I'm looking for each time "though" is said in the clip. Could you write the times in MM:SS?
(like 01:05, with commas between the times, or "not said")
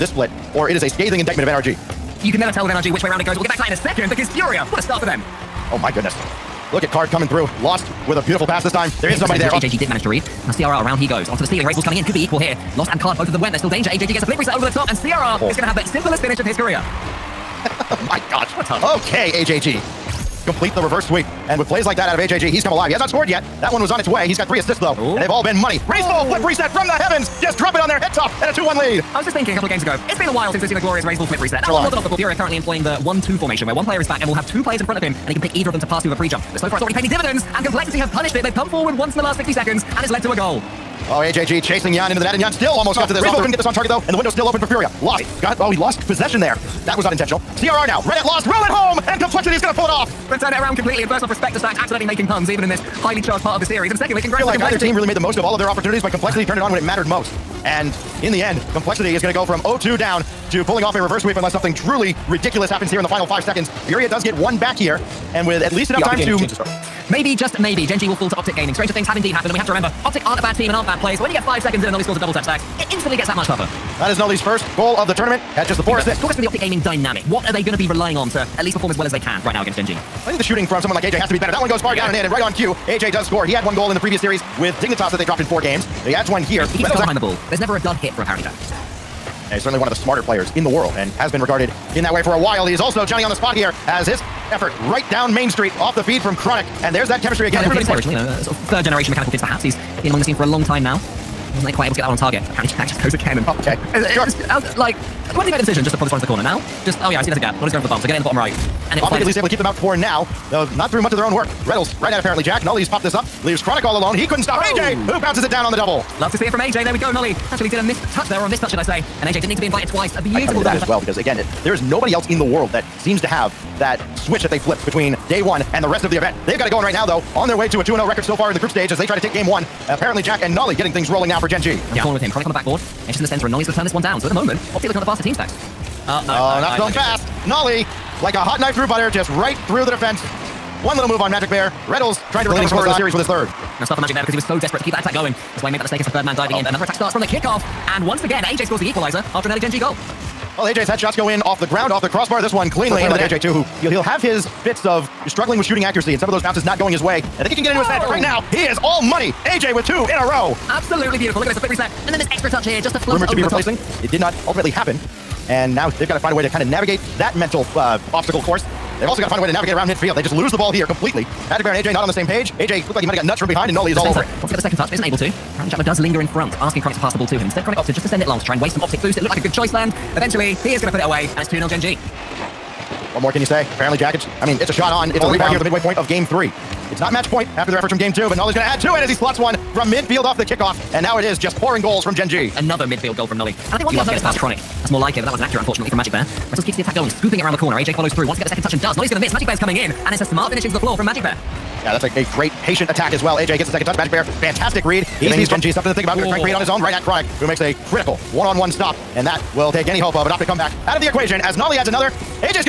00:24, 00:43, 01:50, 02:07.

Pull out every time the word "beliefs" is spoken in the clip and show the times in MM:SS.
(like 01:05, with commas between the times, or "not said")
not said.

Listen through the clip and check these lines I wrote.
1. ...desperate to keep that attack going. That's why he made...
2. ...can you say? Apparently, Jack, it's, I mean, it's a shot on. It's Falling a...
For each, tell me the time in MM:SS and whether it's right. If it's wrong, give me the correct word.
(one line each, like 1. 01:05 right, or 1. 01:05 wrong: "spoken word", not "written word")
1. 02:24 right
2. 03:03 right.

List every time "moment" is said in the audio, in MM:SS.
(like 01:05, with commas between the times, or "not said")
02:14.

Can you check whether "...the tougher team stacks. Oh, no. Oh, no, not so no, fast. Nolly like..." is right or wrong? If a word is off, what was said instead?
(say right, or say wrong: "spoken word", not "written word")
wrong: "faster", not "tougher".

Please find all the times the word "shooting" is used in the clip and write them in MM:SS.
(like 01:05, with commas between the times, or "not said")
01:20, 02:35.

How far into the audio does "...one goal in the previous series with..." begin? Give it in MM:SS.
01:23.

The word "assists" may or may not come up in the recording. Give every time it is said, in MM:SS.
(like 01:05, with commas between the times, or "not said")
00:24, 01:15.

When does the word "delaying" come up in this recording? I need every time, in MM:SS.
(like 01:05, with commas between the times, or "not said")
not said.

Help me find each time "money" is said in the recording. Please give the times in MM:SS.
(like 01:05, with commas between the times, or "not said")
00:25, 02:38.